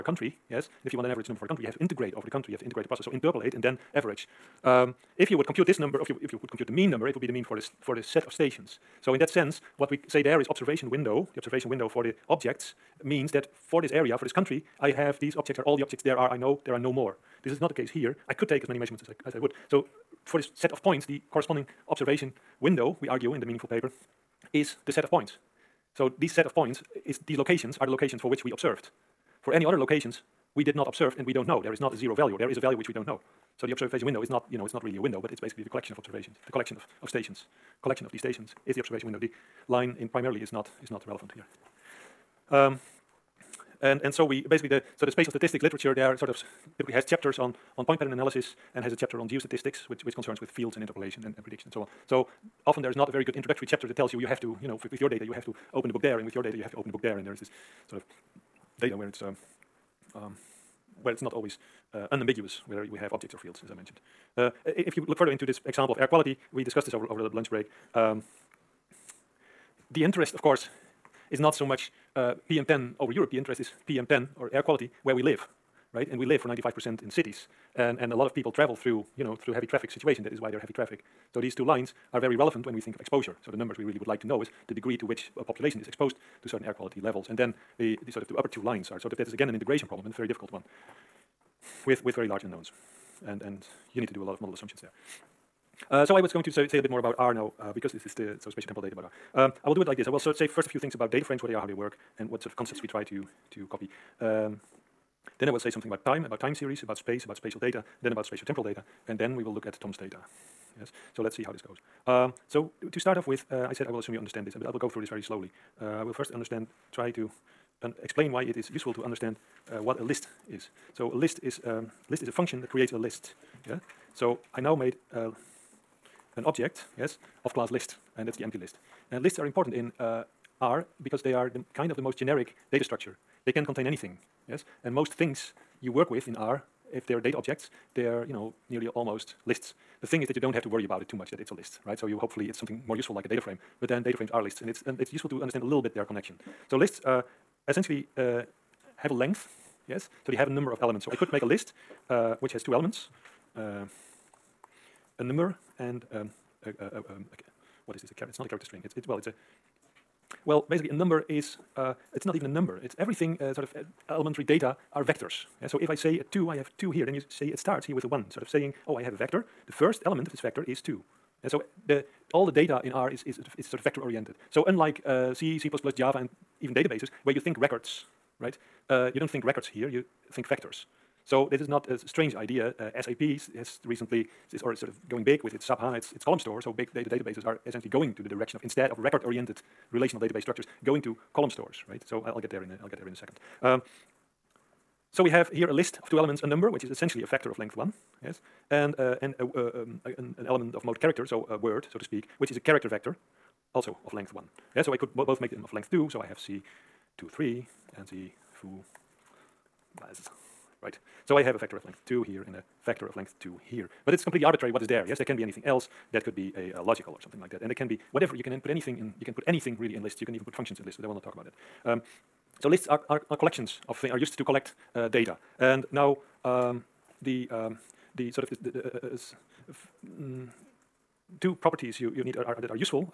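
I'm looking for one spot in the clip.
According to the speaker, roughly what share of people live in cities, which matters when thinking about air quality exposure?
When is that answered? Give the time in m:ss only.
1:16.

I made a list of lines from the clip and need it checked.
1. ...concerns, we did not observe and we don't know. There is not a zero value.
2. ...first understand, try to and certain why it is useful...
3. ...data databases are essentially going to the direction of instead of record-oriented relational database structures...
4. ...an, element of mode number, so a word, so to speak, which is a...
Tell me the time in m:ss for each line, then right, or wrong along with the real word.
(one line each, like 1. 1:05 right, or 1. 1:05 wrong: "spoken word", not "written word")
1. 0:29 wrong: "locations", not "concerns"
2. 1:56 wrong: "explain", not "certain"
3. 3:06 right
4. 3:20 wrong: "character", not "number".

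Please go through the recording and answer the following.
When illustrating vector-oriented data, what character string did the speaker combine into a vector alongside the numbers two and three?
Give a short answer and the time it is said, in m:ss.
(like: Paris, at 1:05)
foo, at 3:28.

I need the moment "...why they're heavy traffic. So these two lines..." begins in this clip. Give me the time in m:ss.
1:20.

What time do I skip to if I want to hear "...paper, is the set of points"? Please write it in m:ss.
0:23.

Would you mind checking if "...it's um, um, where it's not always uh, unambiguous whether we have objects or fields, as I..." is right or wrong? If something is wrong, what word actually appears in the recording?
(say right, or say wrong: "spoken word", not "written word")
right.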